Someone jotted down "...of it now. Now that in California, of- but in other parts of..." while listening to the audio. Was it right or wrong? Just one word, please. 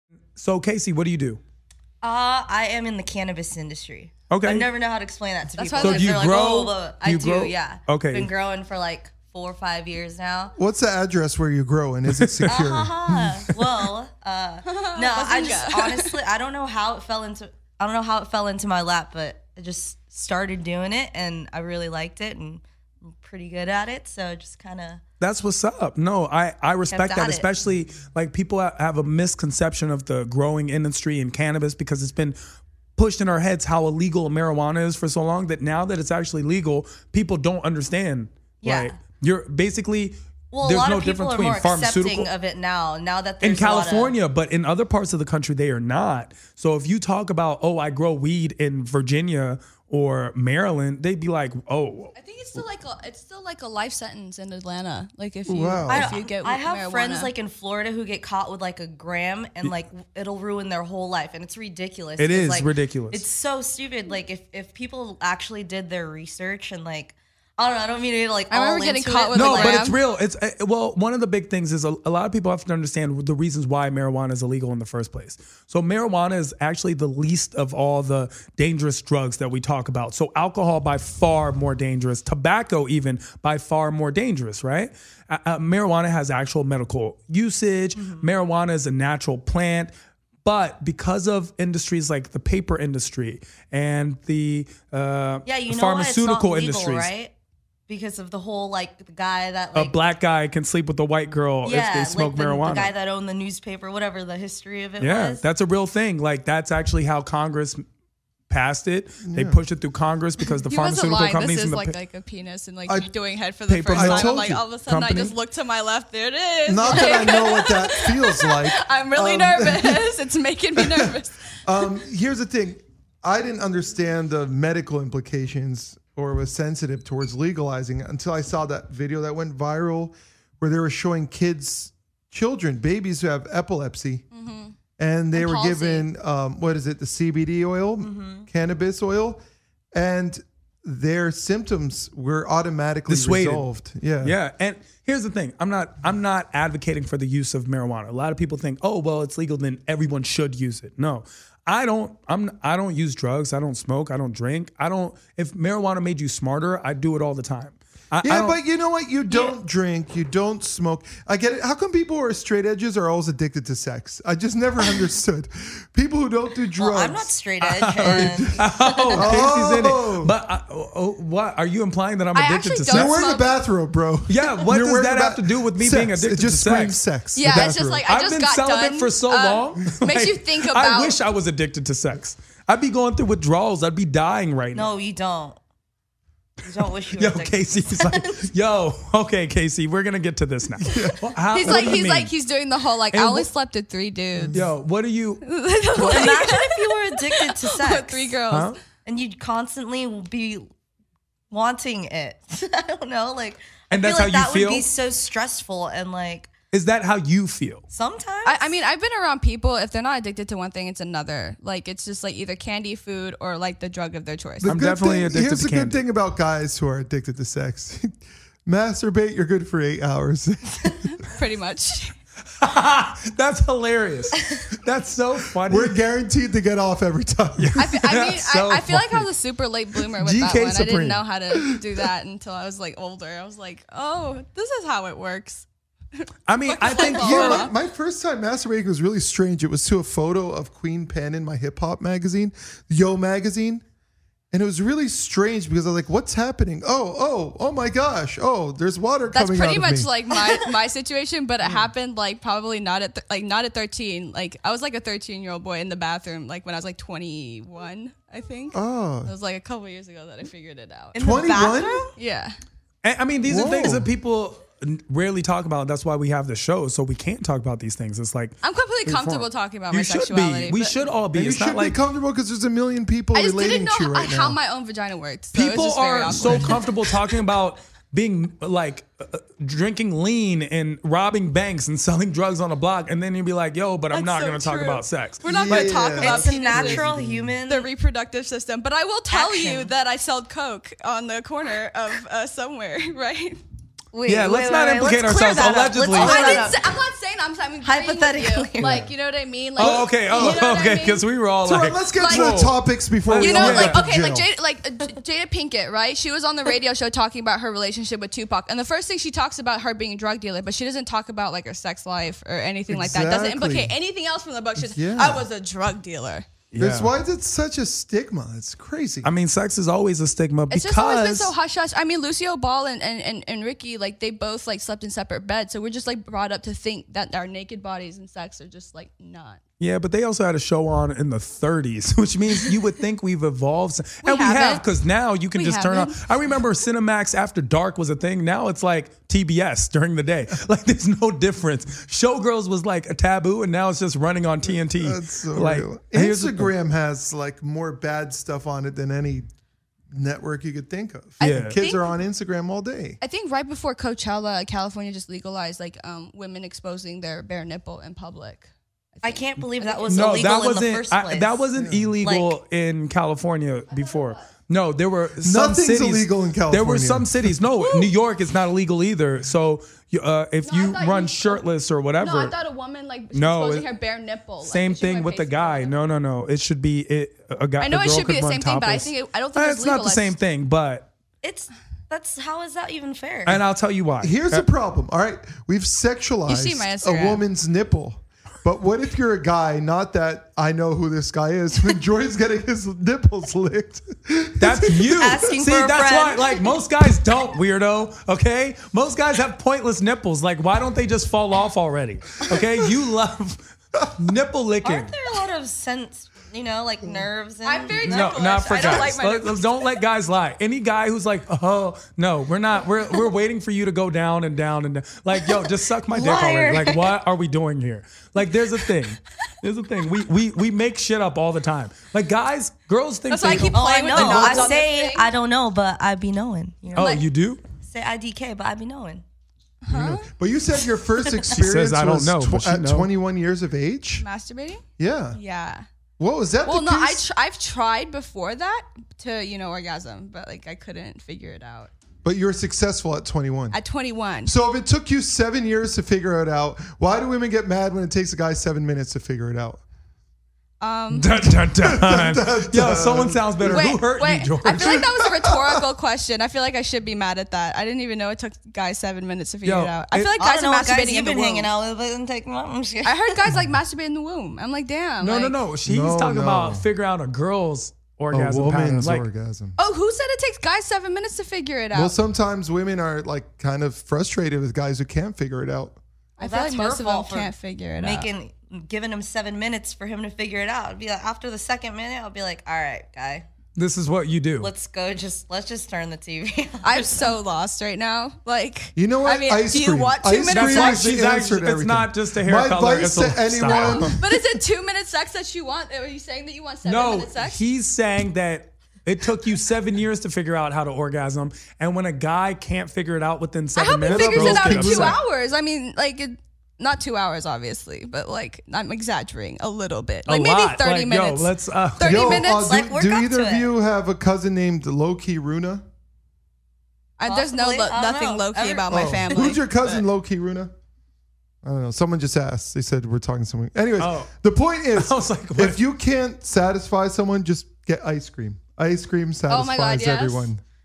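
right.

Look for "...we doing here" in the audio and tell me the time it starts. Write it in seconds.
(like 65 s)
417 s.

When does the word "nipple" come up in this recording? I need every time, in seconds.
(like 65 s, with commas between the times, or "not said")
357 s, 374 s, 387 s, 392 s, 400 s, 404 s.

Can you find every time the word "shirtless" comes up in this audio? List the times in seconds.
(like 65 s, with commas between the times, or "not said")
371 s.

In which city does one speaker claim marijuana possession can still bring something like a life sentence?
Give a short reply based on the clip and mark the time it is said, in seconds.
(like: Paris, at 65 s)
Atlanta, at 54 s.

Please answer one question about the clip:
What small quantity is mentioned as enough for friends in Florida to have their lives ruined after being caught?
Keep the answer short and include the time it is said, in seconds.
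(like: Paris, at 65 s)
a gram, at 58 s.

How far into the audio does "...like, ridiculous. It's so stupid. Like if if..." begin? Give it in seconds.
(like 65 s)
62 s.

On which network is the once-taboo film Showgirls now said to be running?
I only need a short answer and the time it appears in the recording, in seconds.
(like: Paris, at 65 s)
TNT, at 344 s.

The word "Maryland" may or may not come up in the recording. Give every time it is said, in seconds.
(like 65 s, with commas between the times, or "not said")
50 s.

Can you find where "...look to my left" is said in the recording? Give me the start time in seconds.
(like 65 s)
115 s.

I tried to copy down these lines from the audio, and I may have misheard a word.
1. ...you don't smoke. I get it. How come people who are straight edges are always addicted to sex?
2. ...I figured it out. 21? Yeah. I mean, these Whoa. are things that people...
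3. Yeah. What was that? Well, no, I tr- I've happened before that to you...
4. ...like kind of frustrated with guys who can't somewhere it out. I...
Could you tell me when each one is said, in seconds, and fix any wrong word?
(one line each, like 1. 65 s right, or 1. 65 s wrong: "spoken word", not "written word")
1. 160 s right
2. 260 s right
3. 435 s wrong: "tried", not "happened"
4. 473 s wrong: "figure", not "somewhere".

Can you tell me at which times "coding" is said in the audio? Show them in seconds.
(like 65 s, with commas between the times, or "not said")
not said.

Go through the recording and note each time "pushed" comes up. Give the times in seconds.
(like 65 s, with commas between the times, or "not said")
32 s, 109 s.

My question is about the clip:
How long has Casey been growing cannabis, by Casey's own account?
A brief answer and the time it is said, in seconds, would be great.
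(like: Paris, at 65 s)
4 or 5 years, at 9 s.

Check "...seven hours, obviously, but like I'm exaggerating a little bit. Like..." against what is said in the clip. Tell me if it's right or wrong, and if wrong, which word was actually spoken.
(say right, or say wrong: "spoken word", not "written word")
wrong: "two", not "seven".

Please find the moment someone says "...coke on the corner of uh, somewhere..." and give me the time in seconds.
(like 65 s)
290 s.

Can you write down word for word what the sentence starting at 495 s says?
Are you saying that you want seven no, minute sex?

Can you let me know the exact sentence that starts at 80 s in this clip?
So alcohol by far more dangerous.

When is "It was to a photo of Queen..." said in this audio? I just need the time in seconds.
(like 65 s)
239 s.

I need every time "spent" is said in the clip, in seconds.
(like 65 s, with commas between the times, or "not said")
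not said.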